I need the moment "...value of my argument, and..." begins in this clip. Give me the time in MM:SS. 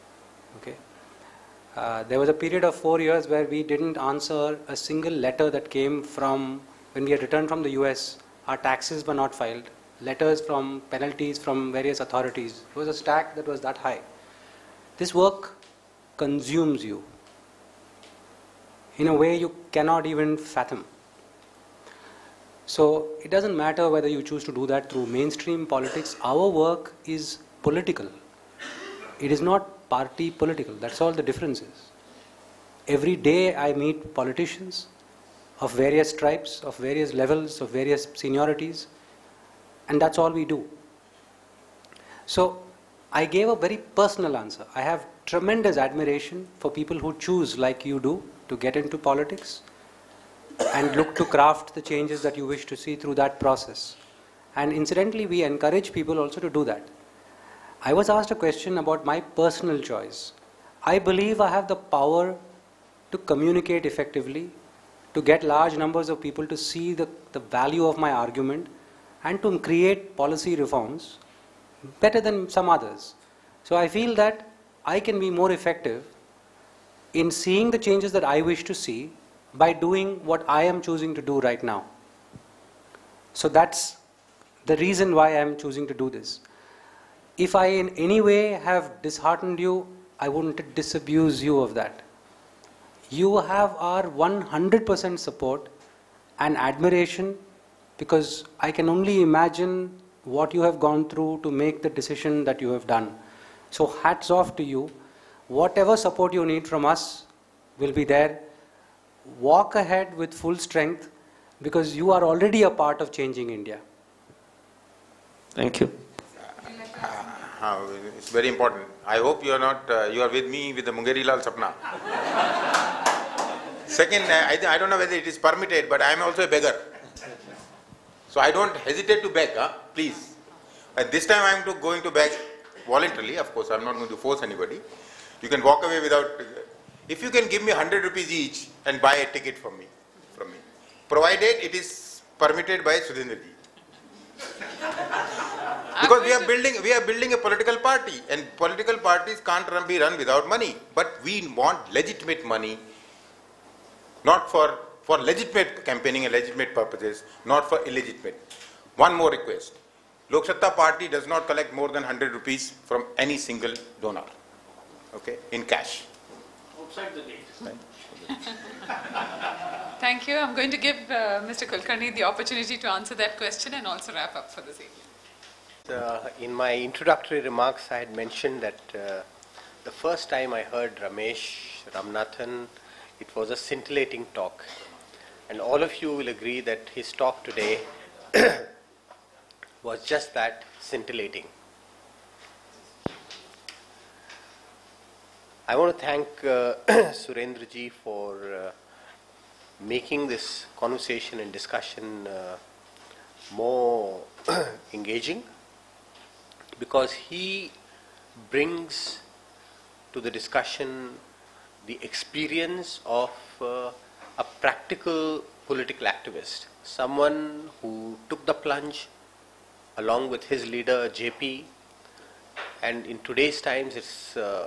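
01:07.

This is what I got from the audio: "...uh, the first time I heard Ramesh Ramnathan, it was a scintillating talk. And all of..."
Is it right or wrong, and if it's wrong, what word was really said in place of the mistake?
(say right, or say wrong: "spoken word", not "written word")
right.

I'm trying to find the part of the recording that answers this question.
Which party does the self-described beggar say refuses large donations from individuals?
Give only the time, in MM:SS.
02:40.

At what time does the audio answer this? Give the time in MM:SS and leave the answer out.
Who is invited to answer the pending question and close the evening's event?
02:51.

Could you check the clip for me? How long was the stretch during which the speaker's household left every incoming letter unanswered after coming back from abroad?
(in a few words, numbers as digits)
4 years.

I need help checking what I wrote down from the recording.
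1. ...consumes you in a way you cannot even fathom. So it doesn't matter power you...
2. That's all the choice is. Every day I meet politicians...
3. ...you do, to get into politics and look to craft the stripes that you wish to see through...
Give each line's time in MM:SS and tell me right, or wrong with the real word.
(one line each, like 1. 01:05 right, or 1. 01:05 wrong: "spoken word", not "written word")
1. 00:16 wrong: "whether", not "power"
2. 00:30 wrong: "difference", not "choice"
3. 00:47 wrong: "changes", not "stripes".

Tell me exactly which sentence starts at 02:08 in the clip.
So I don't hesitate to beg, huh?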